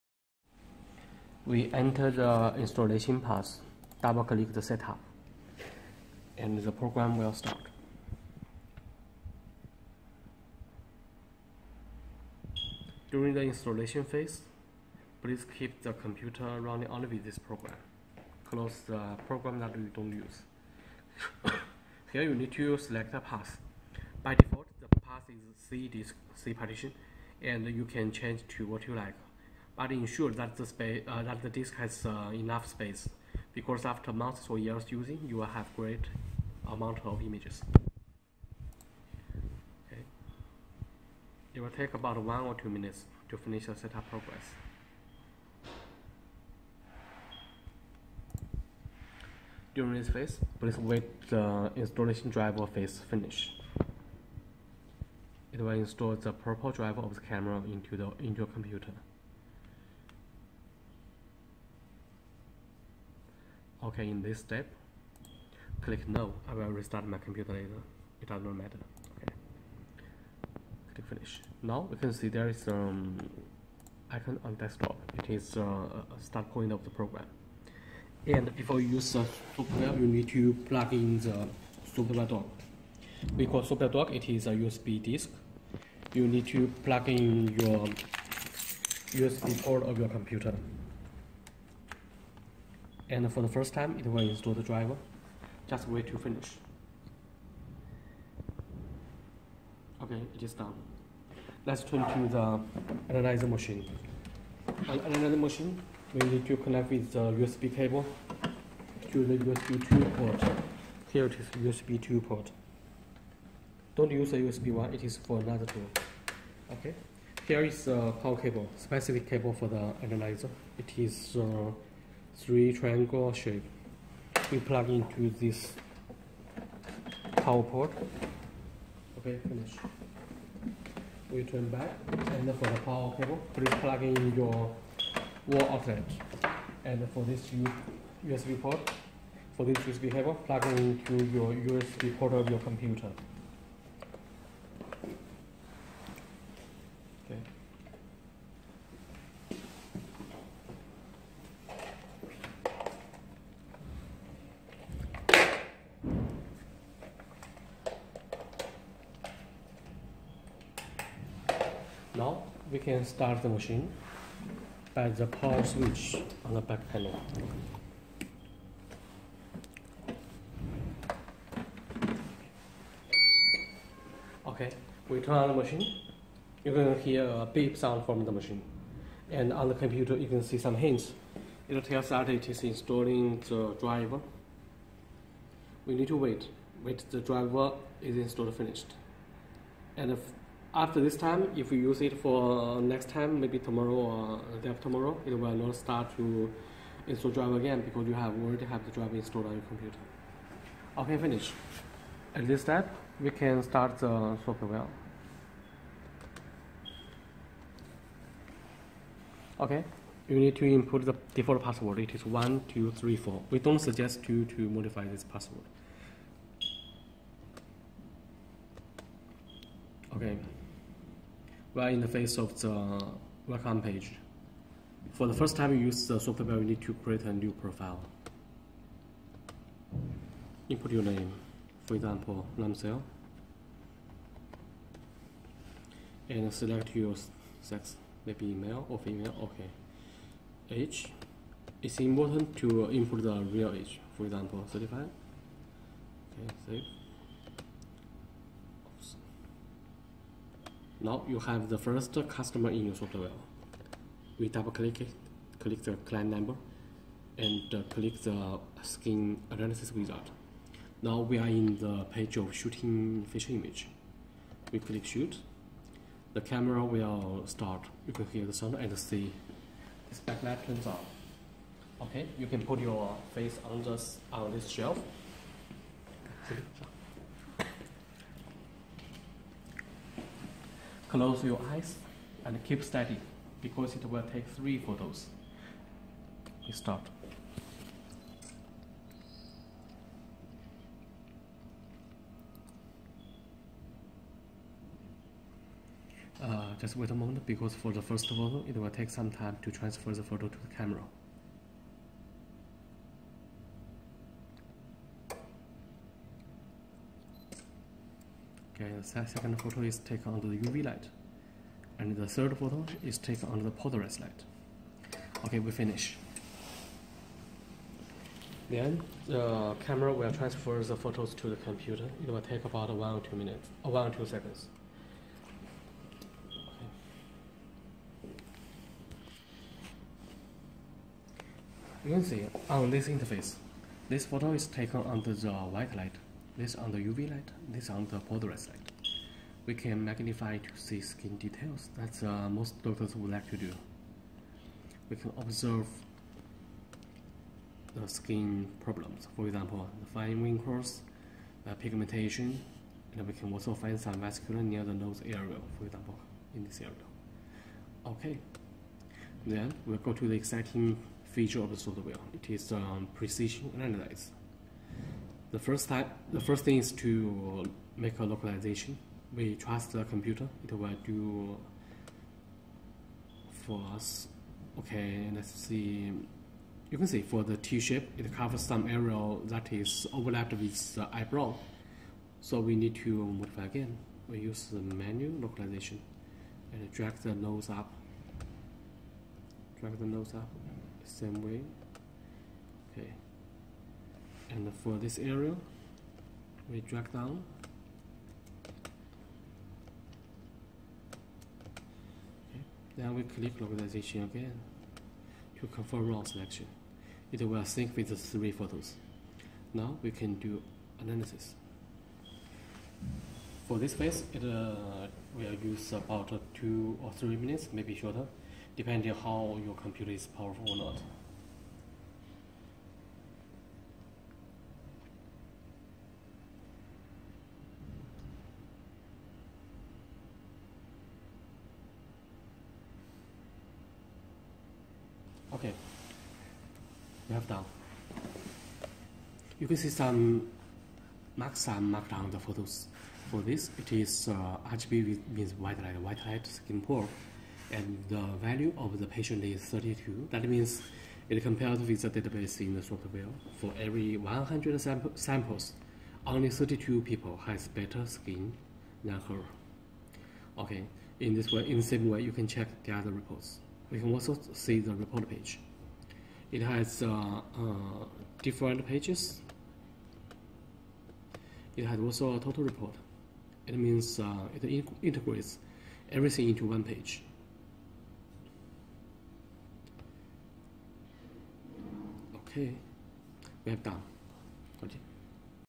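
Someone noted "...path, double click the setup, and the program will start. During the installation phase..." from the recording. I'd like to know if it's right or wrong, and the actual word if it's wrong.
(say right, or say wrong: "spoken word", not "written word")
right.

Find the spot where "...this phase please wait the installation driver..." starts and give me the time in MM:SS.
00:49.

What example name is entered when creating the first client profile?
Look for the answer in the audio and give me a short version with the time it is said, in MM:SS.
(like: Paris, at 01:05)
Ramsel, at 03:52.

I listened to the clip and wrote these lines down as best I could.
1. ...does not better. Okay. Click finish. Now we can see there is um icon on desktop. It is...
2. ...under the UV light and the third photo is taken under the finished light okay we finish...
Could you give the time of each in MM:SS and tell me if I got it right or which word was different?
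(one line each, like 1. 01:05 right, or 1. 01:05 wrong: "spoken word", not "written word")
1. 01:08 wrong: "matter", not "better"
2. 05:10 wrong: "polarized", not "finished".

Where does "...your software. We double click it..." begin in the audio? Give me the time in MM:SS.
04:12.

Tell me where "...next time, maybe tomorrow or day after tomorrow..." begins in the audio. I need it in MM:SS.
03:12.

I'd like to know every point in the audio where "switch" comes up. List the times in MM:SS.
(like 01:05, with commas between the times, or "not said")
02:45.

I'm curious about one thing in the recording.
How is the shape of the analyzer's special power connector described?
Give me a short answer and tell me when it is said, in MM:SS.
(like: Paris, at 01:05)
Three triangle shape, at 02:02.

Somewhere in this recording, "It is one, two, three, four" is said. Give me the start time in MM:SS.
03:31.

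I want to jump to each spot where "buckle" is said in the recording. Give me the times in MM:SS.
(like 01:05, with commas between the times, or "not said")
not said.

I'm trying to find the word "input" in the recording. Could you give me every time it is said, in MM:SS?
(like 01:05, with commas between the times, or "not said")
03:30, 03:50, 04:02.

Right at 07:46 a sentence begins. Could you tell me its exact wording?
It has uh, uh, different pages.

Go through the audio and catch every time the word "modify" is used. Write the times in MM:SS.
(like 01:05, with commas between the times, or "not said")
03:34, 06:23.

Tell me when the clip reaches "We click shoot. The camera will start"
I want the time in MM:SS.
04:24.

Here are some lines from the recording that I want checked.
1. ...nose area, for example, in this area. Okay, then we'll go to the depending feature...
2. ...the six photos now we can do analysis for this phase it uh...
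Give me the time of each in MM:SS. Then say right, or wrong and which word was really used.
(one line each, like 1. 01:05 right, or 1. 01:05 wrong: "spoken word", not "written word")
1. 05:54 wrong: "exciting", not "depending"
2. 06:48 wrong: "three", not "six".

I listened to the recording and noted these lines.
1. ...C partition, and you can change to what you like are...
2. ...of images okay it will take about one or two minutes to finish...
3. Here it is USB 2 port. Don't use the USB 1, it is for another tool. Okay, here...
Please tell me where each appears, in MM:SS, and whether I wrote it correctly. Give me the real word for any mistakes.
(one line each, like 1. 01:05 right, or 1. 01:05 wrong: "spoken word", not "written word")
1. 00:26 right
2. 00:37 right
3. 01:51 right.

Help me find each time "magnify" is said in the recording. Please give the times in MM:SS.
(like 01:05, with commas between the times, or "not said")
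05:40.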